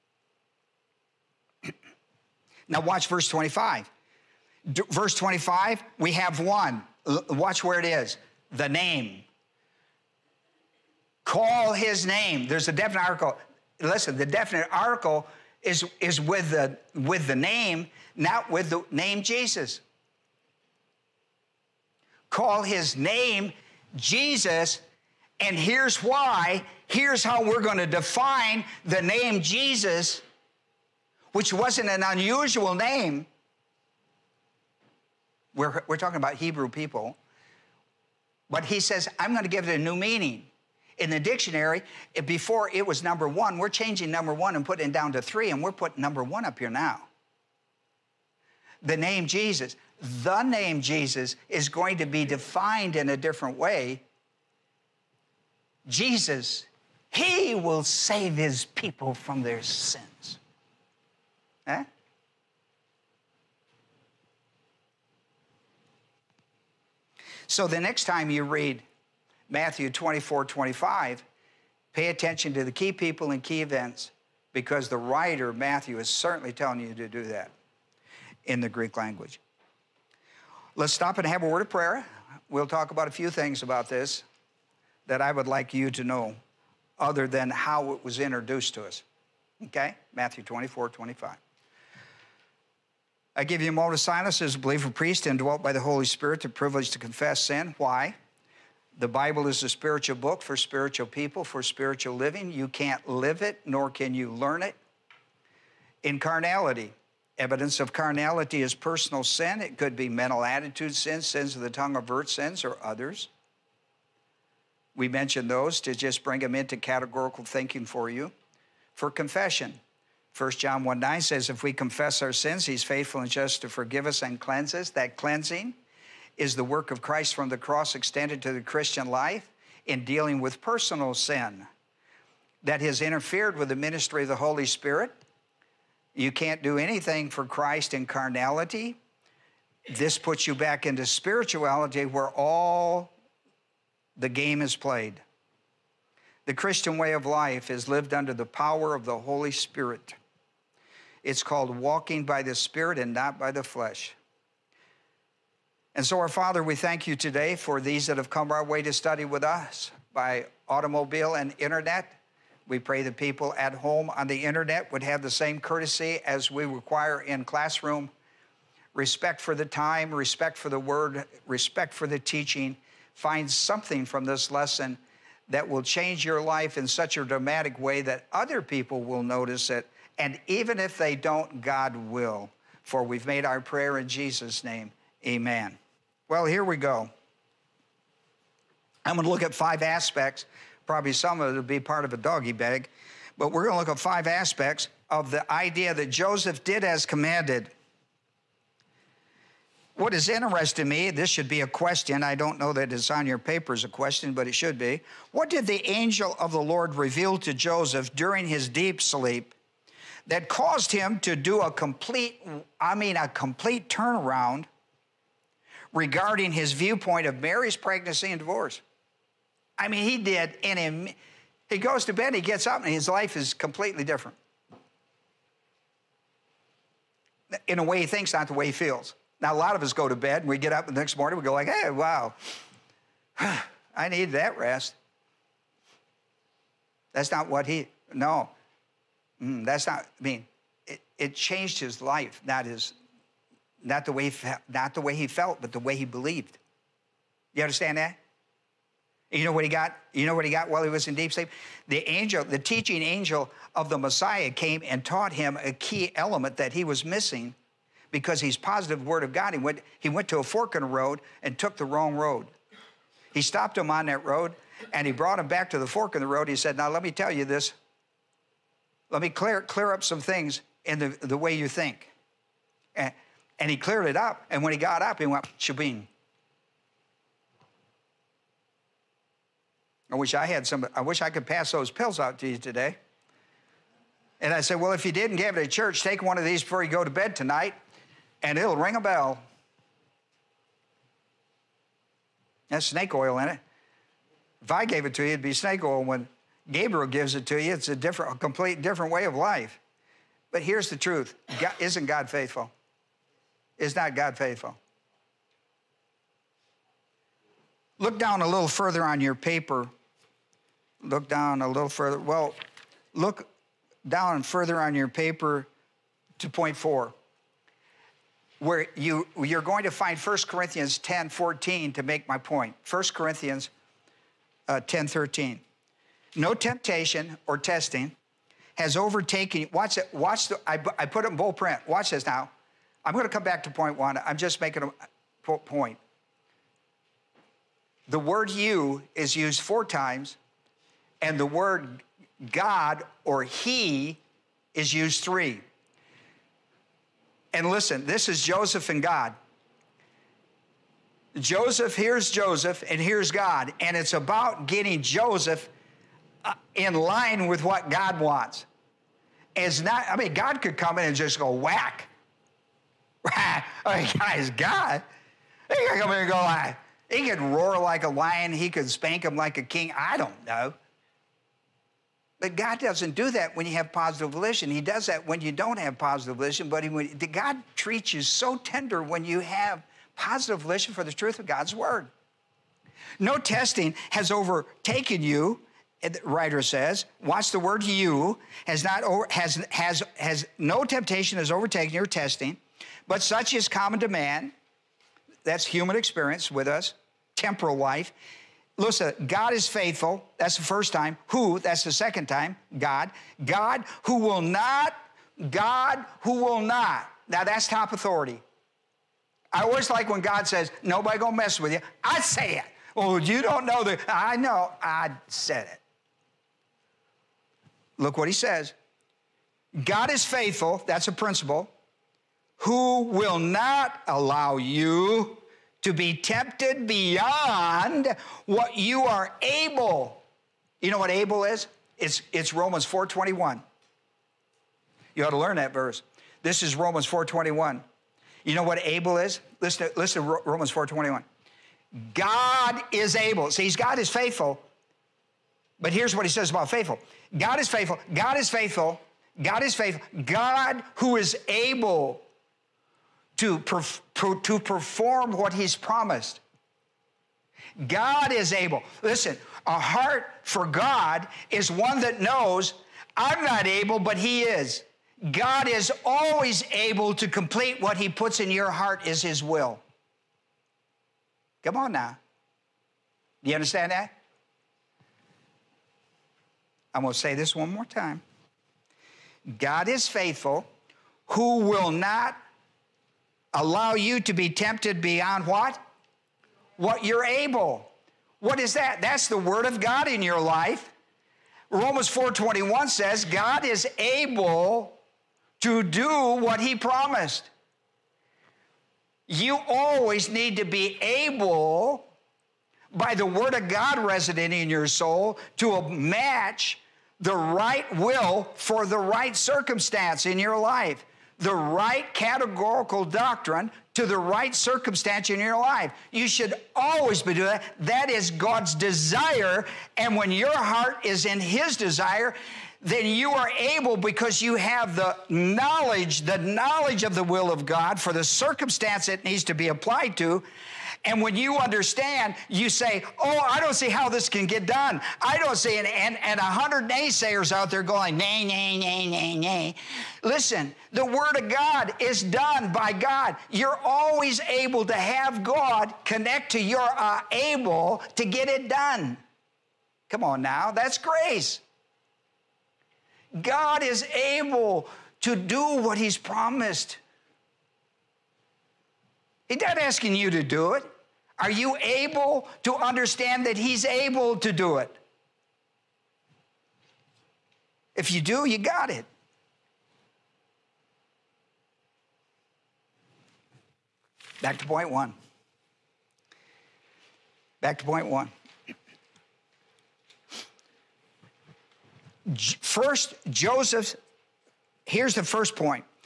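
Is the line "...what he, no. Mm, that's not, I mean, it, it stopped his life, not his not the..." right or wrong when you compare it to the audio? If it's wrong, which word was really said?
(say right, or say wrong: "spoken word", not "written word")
wrong: "changed", not "stopped".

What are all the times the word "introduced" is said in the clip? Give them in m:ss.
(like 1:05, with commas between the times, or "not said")
1:28.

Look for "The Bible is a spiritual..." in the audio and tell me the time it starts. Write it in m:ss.
1:38.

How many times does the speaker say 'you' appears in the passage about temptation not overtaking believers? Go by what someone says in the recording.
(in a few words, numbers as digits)
4.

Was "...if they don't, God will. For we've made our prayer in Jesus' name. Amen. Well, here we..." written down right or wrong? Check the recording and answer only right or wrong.
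right.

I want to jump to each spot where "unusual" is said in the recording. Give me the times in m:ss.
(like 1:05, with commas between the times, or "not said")
0:32.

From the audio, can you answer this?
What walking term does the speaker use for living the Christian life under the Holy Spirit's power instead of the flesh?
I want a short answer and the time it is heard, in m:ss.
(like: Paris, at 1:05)
walking by the Spirit, at 2:31.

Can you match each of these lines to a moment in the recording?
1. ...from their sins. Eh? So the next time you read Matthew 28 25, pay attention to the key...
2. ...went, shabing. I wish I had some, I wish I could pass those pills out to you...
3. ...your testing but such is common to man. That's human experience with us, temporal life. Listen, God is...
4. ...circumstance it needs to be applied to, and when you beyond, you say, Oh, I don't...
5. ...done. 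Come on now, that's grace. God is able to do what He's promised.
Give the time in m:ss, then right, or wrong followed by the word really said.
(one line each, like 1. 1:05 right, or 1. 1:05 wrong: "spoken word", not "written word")
1. 0:59 wrong: "24", not "28"
2. 4:35 right
3. 6:31 right
4. 8:48 wrong: "understand", not "beyond"
5. 9:08 right.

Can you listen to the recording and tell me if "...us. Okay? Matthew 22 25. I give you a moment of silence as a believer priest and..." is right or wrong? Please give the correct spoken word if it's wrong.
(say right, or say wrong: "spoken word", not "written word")
wrong: "24", not "22".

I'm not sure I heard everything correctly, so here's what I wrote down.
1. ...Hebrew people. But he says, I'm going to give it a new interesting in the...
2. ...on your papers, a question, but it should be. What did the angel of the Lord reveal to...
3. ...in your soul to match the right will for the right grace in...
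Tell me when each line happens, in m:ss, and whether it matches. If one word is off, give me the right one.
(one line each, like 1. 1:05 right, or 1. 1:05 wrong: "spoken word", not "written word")
1. 0:36 wrong: "meaning", not "interesting"
2. 3:23 right
3. 8:24 wrong: "circumstance", not "grace".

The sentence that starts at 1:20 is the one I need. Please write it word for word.
Let's stop and have a word of prayer.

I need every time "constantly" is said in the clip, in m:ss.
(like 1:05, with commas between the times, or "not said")
not said.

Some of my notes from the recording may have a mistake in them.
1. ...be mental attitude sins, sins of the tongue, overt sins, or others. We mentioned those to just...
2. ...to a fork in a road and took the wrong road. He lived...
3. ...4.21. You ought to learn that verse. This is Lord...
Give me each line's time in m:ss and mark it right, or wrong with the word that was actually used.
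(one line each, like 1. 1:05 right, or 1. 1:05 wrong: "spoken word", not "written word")
1. 1:49 right
2. 4:20 wrong: "stopped", not "lived"
3. 7:12 wrong: "Romans", not "Lord".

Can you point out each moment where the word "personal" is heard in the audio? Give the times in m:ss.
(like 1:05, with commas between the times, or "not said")
1:48, 2:10.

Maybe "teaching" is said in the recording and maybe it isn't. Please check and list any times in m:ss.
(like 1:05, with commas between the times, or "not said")
2:52, 4:12.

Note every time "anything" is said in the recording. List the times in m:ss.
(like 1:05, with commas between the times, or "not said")
2:16.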